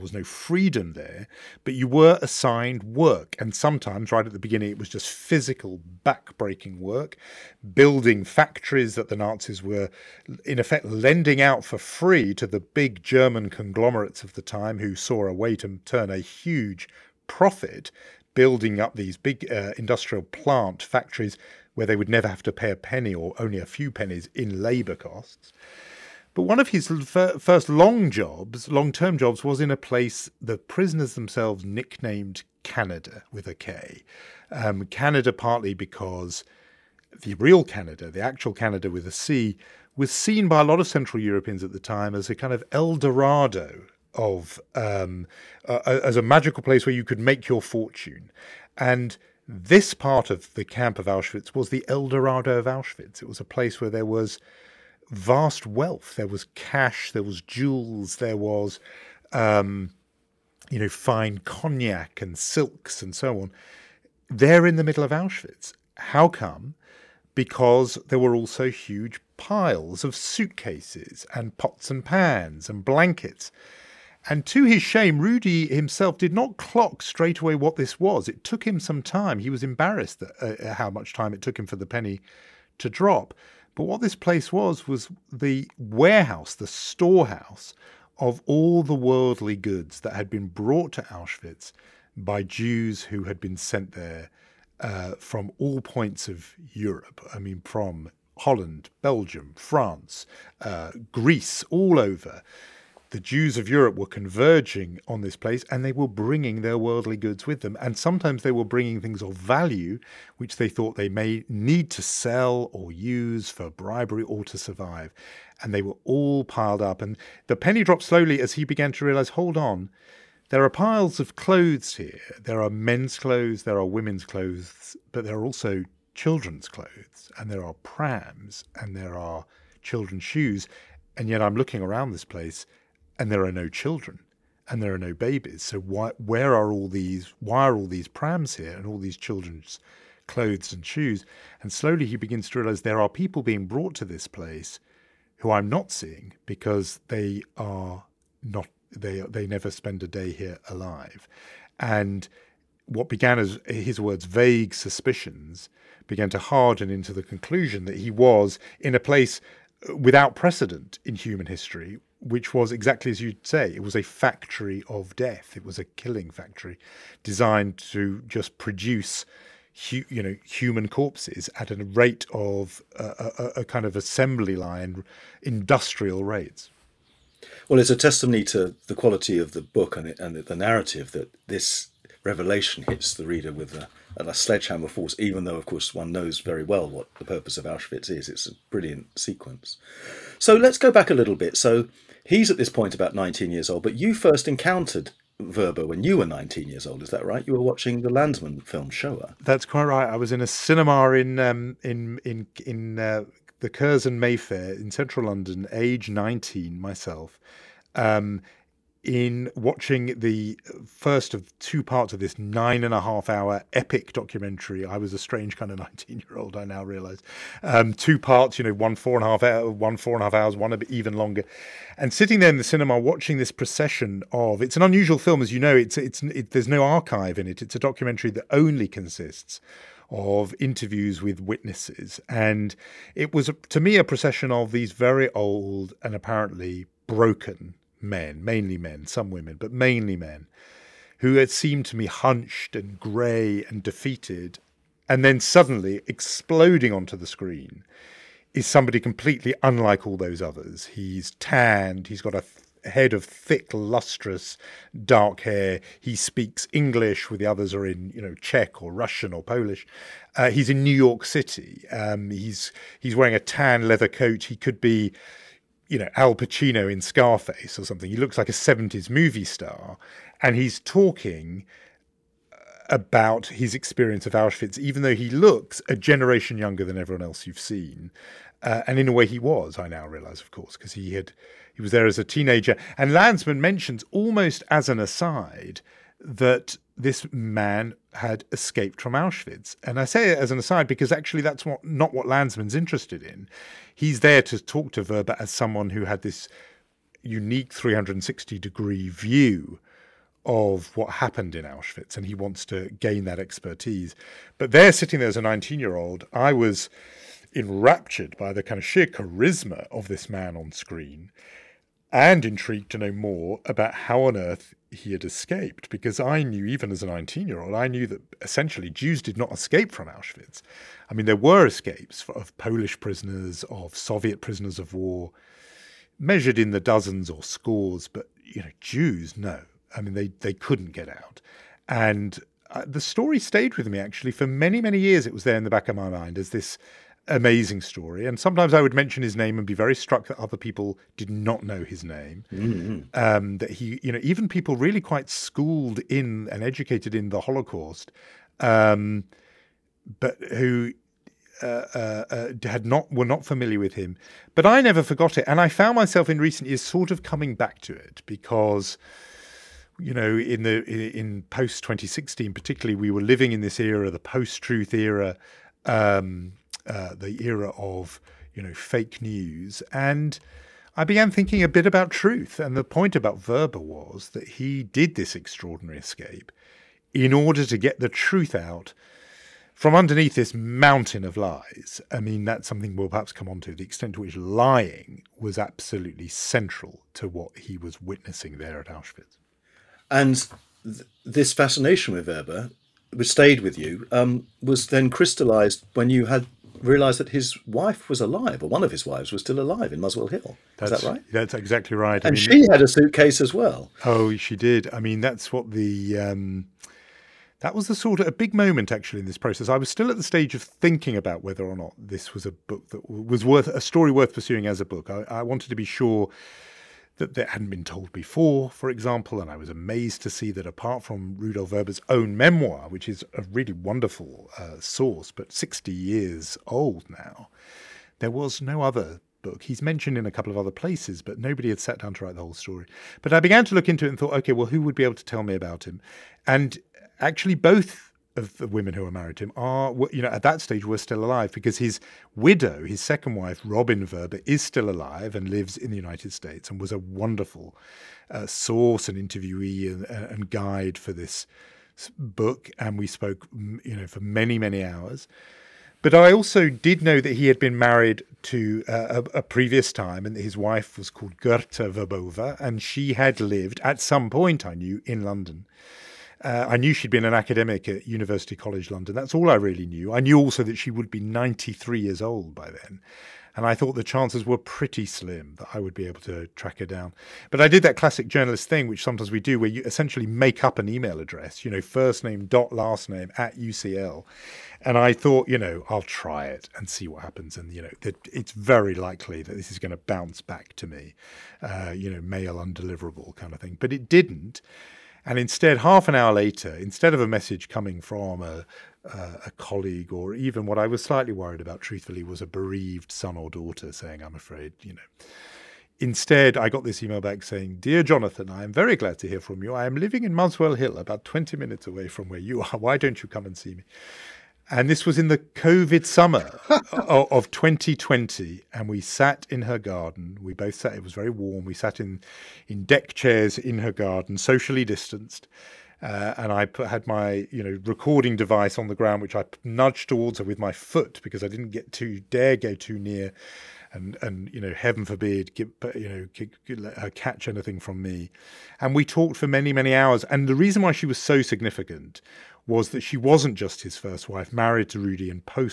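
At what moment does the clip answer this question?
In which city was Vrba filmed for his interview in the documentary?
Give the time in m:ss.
4:20.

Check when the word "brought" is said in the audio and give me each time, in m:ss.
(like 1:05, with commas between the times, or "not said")
1:30, 2:23.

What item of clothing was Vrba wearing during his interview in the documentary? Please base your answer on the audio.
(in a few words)
tan leather coat.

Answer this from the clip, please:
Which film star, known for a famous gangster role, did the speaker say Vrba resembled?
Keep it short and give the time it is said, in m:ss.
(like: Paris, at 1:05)
Al Pacino, at 4:26.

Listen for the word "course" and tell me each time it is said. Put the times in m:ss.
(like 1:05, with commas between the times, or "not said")
3:05, 4:40.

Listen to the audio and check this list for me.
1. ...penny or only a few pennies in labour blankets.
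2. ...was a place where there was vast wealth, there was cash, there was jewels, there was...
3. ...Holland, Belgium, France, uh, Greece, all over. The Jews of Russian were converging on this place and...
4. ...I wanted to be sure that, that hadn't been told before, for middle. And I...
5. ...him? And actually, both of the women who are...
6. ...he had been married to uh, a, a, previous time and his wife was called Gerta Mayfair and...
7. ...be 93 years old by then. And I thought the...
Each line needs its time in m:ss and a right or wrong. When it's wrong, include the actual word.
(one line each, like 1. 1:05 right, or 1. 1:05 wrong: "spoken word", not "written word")
1. 0:22 wrong: "costs", not "blankets"
2. 0:53 right
3. 1:38 wrong: "Europe", not "Russian"
4. 6:55 wrong: "example", not "middle"
5. 7:15 right
6. 7:37 wrong: "Vrbová", not "Mayfair"
7. 7:51 right.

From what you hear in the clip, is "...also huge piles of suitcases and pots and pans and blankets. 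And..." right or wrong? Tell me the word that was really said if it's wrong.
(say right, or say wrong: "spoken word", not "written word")
right.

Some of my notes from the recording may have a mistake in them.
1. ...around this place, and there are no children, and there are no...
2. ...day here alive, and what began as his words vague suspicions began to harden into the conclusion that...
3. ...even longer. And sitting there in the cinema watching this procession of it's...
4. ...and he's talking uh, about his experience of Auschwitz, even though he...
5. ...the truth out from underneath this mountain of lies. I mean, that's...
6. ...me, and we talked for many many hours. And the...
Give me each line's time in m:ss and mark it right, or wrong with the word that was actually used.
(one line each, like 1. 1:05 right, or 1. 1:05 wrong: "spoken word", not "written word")
1. 2:11 right
2. 2:30 right
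3. 3:40 right
4. 4:30 right
5. 6:17 right
6. 8:57 right.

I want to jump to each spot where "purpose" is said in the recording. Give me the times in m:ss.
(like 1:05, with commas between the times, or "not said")
3:07.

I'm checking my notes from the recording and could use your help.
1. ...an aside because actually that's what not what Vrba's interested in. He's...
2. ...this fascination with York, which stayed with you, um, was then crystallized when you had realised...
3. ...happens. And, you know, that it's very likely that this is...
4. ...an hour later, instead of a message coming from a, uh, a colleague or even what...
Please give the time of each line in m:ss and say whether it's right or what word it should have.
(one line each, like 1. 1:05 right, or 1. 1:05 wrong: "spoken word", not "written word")
1. 4:50 wrong: "Lanzmann", not "Vrba"
2. 6:31 wrong: "Vrba", not "York"
3. 8:07 right
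4. 8:16 right.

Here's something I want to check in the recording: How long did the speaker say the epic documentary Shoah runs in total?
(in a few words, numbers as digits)
9 and a half hours.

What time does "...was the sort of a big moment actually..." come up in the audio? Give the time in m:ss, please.
6:47.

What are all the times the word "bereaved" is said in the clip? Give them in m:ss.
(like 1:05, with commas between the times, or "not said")
8:22.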